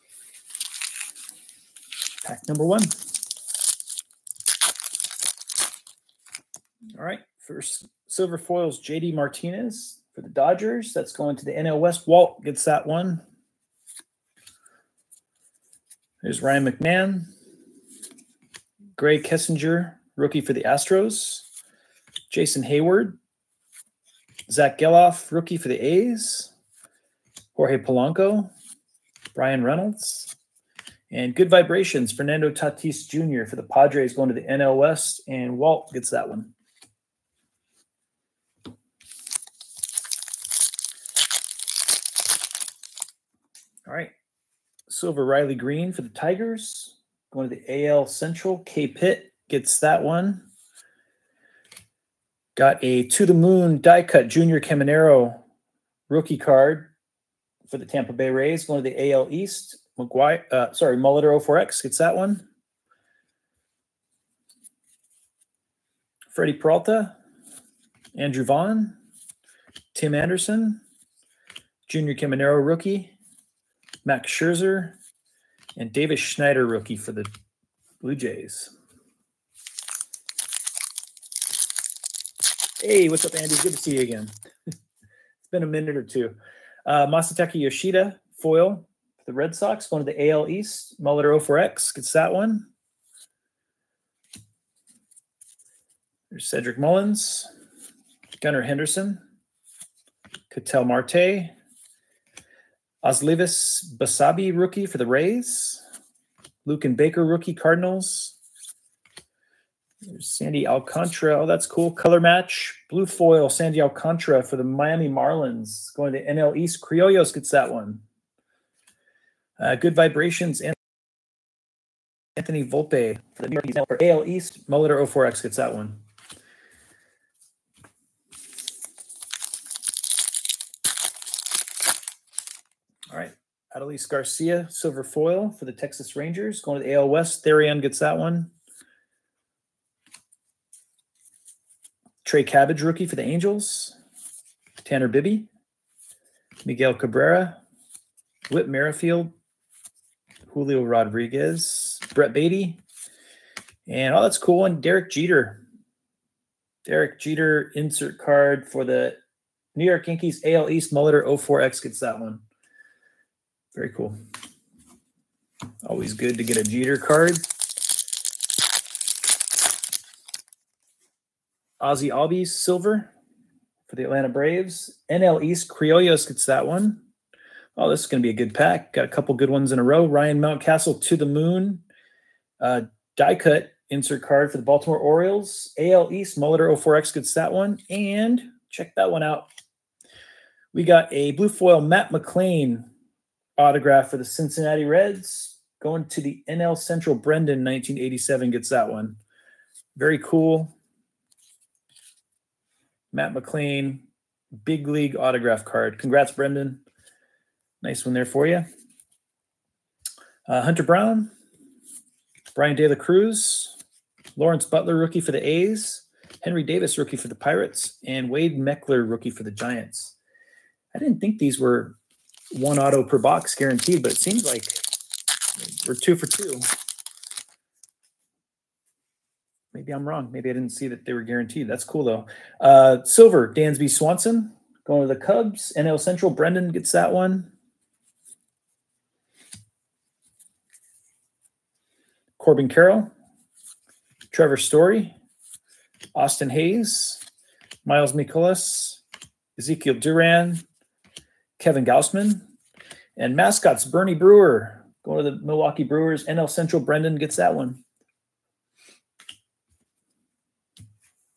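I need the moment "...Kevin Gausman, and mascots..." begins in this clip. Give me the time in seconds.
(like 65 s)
251 s.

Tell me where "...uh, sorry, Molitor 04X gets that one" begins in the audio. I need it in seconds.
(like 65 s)
60 s.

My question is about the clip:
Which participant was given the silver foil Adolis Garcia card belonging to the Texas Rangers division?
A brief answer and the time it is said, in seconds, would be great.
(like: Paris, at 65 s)
Therian, at 137 s.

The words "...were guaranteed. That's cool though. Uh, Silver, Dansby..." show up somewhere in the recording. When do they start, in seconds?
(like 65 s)
231 s.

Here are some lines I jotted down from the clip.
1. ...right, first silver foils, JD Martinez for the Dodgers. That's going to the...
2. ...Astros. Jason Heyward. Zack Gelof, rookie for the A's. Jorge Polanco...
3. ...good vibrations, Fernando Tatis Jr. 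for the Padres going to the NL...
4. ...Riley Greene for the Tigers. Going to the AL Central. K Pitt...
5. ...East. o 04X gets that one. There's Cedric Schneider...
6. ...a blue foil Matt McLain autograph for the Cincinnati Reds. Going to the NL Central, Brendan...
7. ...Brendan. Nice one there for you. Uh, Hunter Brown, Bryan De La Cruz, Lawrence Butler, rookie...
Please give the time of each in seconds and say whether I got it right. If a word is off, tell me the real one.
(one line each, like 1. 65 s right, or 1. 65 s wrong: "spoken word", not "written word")
1. 7 s right
2. 20 s right
3. 31 s right
4. 45 s right
5. 90 s wrong: "Mullins", not "Schneider"
6. 191 s right
7. 206 s right.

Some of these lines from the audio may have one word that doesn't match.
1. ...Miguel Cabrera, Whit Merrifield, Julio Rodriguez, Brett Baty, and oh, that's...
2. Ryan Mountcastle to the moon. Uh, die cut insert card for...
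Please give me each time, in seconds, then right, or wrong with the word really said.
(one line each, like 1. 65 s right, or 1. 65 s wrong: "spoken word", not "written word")
1. 146 s right
2. 180 s right.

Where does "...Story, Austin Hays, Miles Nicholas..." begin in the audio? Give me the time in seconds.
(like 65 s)
244 s.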